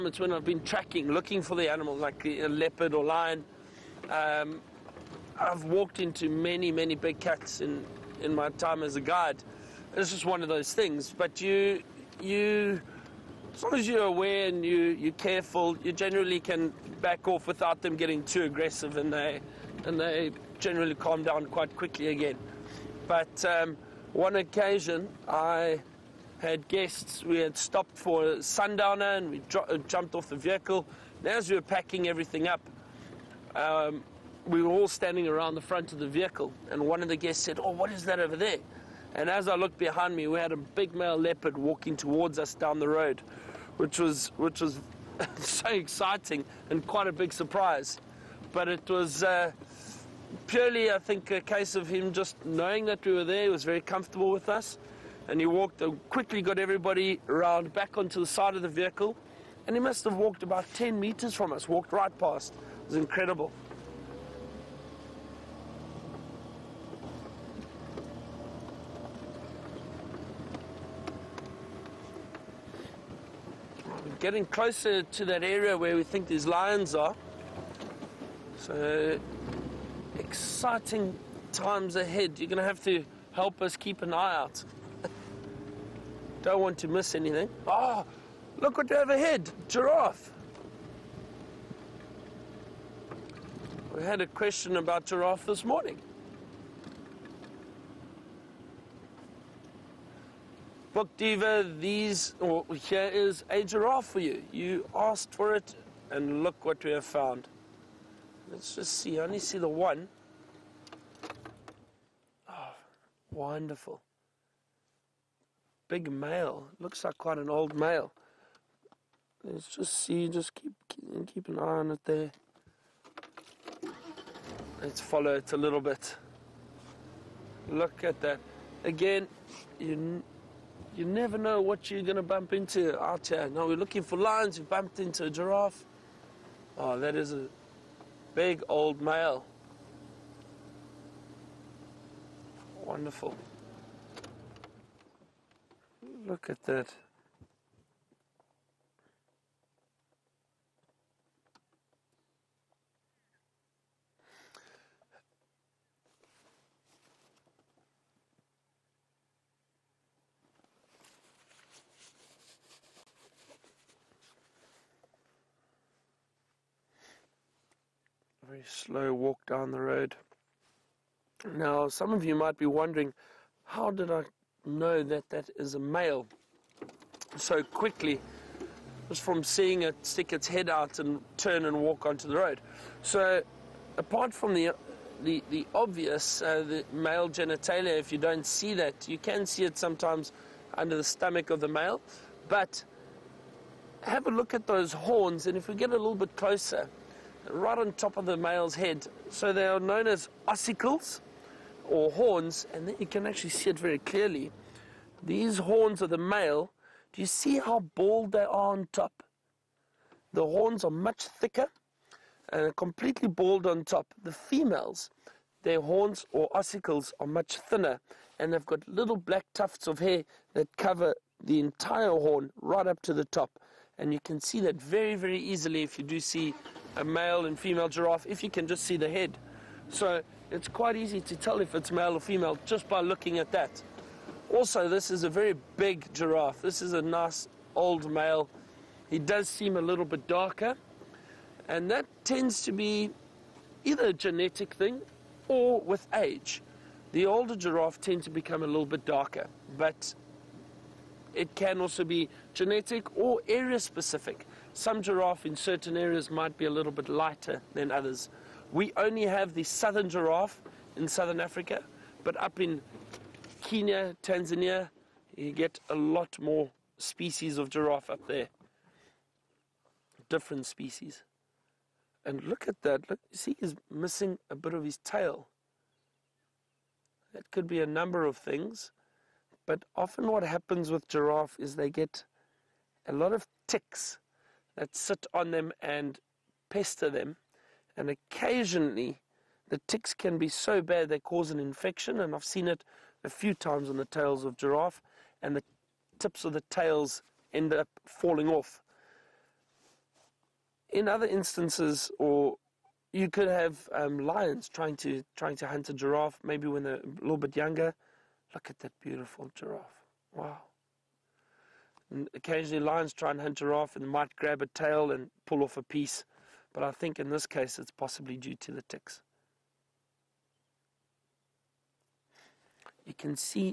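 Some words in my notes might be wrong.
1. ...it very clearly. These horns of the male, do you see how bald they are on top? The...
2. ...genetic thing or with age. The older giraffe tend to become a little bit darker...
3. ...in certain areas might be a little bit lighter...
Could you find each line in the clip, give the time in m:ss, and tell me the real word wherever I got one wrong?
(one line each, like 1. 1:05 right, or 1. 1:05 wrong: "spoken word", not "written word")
1. 3:23 right
2. 4:04 right
3. 4:15 right.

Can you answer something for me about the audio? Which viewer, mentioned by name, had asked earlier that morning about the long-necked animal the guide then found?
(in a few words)
Book Diva.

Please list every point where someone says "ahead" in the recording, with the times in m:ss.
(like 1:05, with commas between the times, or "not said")
1:21, 1:29.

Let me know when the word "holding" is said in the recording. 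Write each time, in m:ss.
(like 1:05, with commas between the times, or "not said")
not said.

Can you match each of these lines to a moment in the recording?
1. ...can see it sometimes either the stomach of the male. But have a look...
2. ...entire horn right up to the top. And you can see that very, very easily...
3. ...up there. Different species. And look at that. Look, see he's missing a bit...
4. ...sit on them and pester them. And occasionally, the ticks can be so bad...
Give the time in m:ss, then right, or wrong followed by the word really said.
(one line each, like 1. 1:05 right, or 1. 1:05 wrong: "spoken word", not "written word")
1. 3:09 wrong: "under", not "either"
2. 3:41 right
3. 4:28 right
4. 4:44 right.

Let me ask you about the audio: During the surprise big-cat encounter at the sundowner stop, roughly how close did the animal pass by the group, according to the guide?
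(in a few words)
10 meters.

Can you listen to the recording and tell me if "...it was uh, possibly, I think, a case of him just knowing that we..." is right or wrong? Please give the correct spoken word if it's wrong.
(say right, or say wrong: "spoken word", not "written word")
wrong: "purely", not "possibly".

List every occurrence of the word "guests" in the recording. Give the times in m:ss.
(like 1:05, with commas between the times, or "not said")
0:26, 0:37.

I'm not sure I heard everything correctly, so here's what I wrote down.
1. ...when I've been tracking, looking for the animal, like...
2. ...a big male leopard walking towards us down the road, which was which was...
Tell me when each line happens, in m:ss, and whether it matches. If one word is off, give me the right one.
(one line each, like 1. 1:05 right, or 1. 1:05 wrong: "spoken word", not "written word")
1. 0:00 right
2. 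0:40 right.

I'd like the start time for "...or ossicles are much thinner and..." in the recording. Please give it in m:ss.
3:36.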